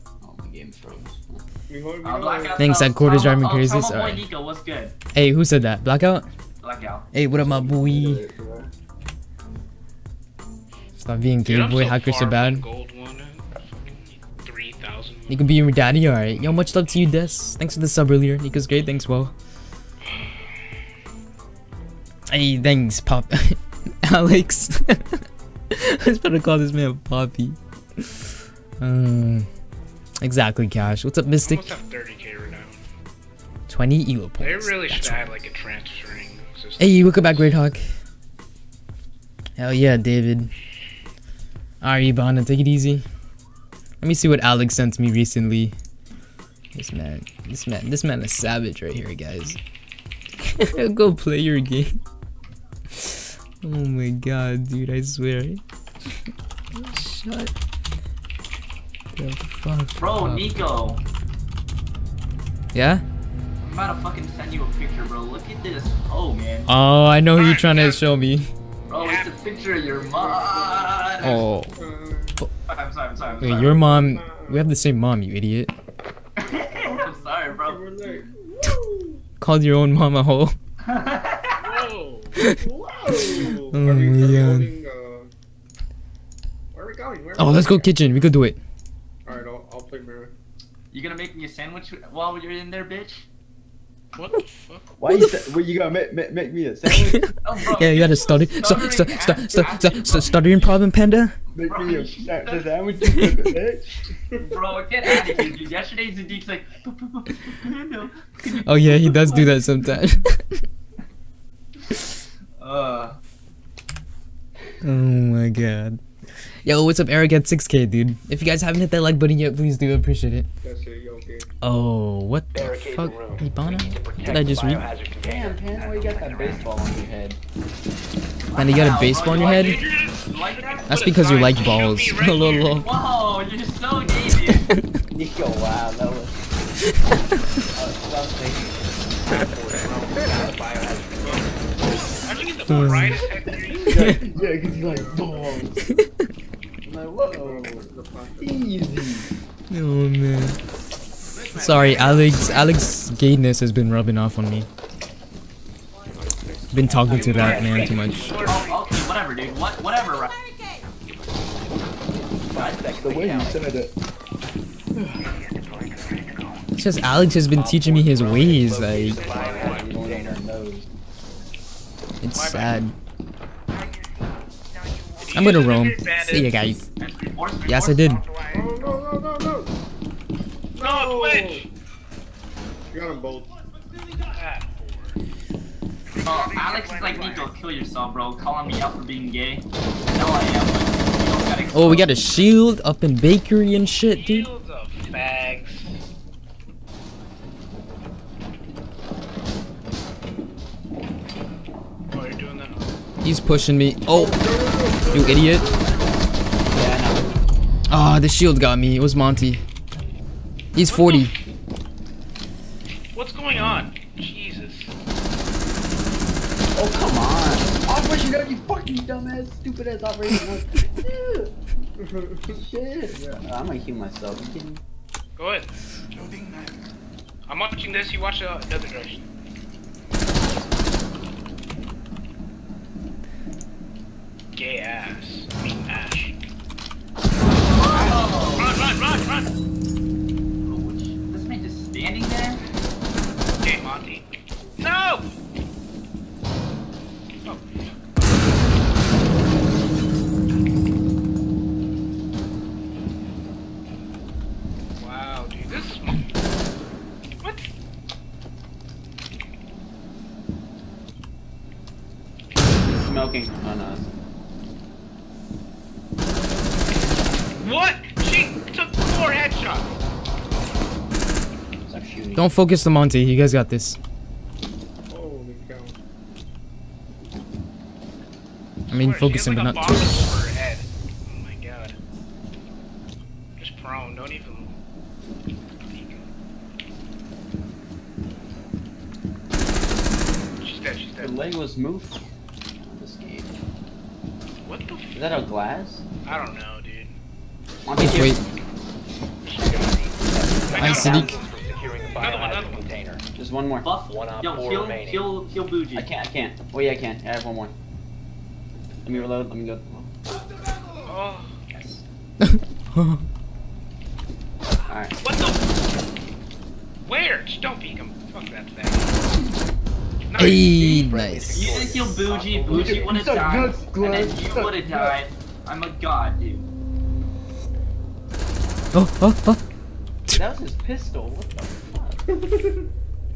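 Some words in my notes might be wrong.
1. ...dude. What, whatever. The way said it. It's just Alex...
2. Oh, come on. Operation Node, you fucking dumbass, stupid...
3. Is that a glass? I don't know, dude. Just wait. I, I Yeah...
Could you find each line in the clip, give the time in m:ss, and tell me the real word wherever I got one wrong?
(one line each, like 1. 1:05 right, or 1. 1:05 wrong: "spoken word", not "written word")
1. 2:39 right
2. 3:36 right
3. 4:54 wrong: "Another", not "Yeah".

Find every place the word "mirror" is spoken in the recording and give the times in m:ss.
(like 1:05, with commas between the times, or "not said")
1:29.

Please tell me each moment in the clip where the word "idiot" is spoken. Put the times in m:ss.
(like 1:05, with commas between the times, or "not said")
1:15, 3:25.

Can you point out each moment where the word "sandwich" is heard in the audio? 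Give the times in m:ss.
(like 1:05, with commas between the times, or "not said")
1:31, 1:36, 1:42.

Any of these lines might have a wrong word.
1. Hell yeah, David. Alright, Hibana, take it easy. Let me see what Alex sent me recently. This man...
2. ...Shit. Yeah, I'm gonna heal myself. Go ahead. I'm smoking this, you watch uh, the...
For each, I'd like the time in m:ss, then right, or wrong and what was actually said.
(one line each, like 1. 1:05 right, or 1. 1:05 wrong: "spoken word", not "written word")
1. 0:39 right
2. 3:42 wrong: "watching", not "smoking".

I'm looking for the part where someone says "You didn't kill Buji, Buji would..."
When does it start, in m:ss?
5:21.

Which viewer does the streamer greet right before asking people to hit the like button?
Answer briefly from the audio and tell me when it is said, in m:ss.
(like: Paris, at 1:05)
Eric, at 1:57.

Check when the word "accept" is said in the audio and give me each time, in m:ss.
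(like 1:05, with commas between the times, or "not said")
not said.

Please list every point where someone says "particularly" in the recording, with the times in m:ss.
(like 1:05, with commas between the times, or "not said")
not said.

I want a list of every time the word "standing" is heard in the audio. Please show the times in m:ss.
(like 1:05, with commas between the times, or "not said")
4:01.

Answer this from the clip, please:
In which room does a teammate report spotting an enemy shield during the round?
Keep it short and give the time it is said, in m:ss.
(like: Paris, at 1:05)
Bakery, at 3:13.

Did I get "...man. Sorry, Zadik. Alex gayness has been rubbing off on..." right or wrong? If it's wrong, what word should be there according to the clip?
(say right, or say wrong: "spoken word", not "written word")
wrong: "Alex", not "Zadik".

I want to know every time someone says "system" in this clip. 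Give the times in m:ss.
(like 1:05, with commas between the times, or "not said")
0:36.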